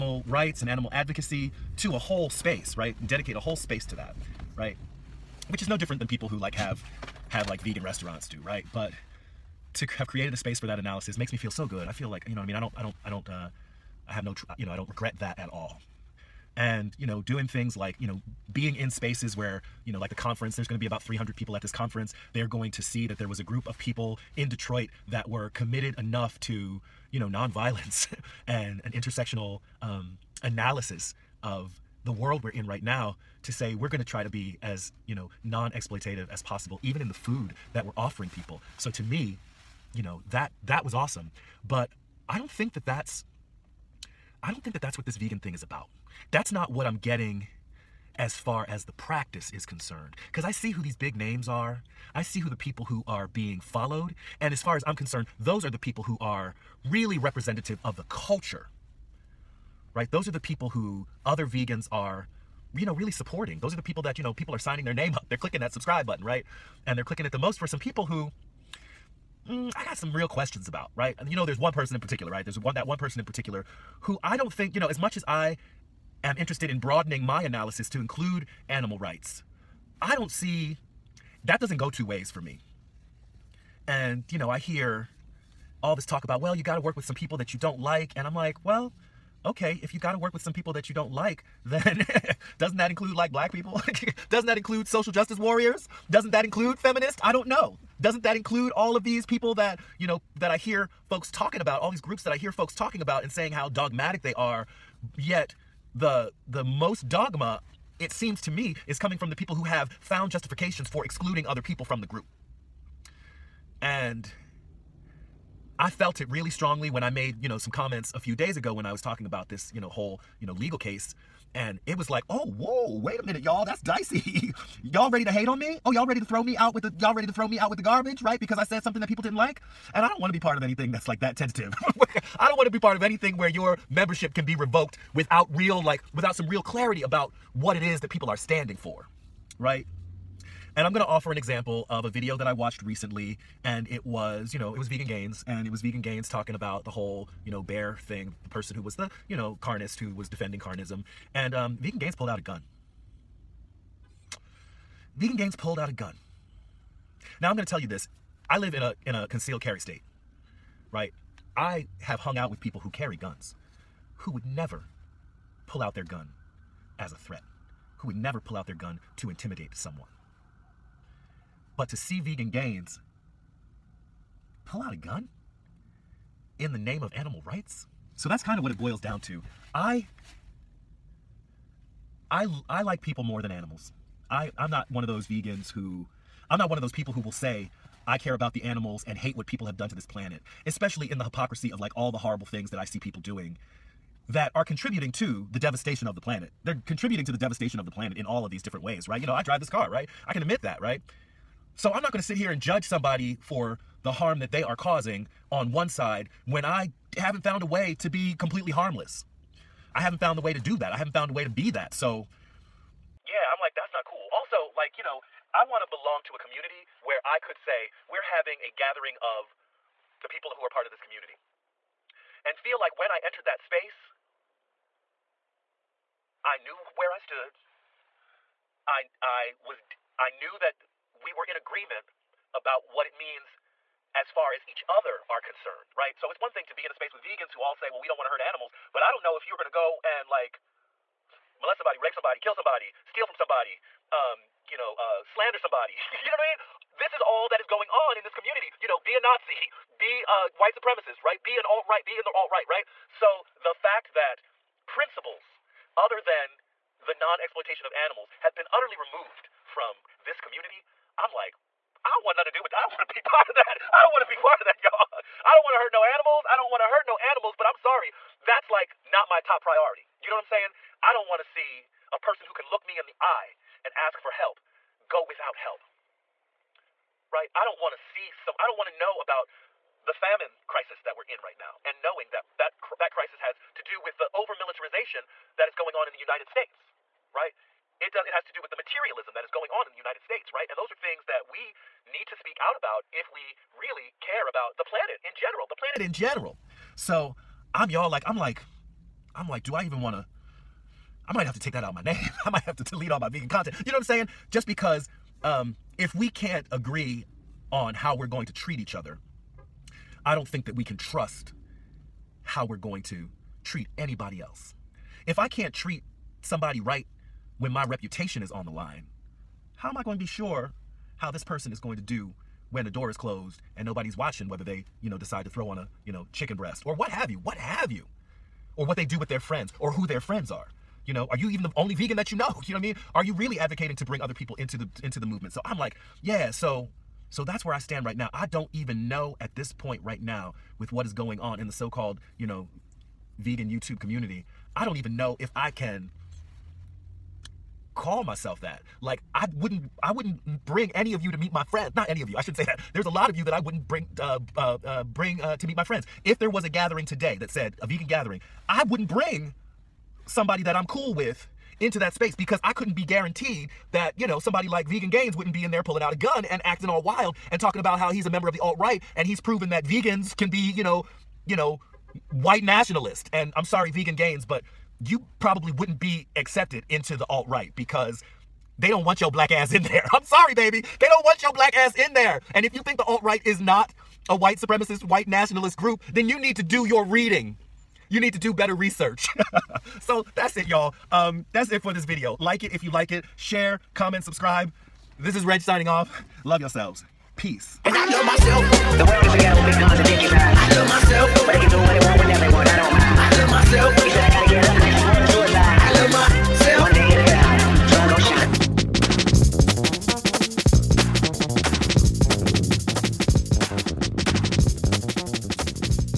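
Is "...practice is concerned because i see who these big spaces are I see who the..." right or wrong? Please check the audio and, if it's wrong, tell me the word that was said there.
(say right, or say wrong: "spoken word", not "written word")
wrong: "names", not "spaces".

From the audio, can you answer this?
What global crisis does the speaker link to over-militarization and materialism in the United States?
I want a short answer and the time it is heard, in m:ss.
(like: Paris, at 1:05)
famine, at 4:40.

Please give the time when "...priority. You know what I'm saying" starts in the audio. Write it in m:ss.
4:29.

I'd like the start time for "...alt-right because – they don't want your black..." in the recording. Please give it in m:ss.
6:17.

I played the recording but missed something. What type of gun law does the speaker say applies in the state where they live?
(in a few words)
concealed carry.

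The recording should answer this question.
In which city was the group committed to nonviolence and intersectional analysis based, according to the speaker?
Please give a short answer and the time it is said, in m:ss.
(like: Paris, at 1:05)
Detroit, at 0:24.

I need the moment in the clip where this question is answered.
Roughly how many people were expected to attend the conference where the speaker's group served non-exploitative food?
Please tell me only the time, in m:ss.
0:21.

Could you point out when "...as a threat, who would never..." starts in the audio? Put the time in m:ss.
2:46.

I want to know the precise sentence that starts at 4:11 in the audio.
Be an alt-right, be in the alt-right, right?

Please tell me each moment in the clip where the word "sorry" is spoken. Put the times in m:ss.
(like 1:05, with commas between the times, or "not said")
4:27, 6:13, 6:20.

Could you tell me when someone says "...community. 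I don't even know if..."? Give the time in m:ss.
5:43.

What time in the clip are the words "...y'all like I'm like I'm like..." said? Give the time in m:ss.
4:57.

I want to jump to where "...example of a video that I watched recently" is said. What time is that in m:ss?
2:21.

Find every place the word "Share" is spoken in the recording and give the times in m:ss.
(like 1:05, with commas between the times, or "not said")
6:33.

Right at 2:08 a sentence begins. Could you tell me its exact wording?
Because I said something that people didn't like.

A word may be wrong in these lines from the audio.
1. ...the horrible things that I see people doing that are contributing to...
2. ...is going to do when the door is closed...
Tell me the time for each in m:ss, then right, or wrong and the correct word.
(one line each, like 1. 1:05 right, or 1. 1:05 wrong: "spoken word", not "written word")
1. 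3:12 right
2. 5:21 right.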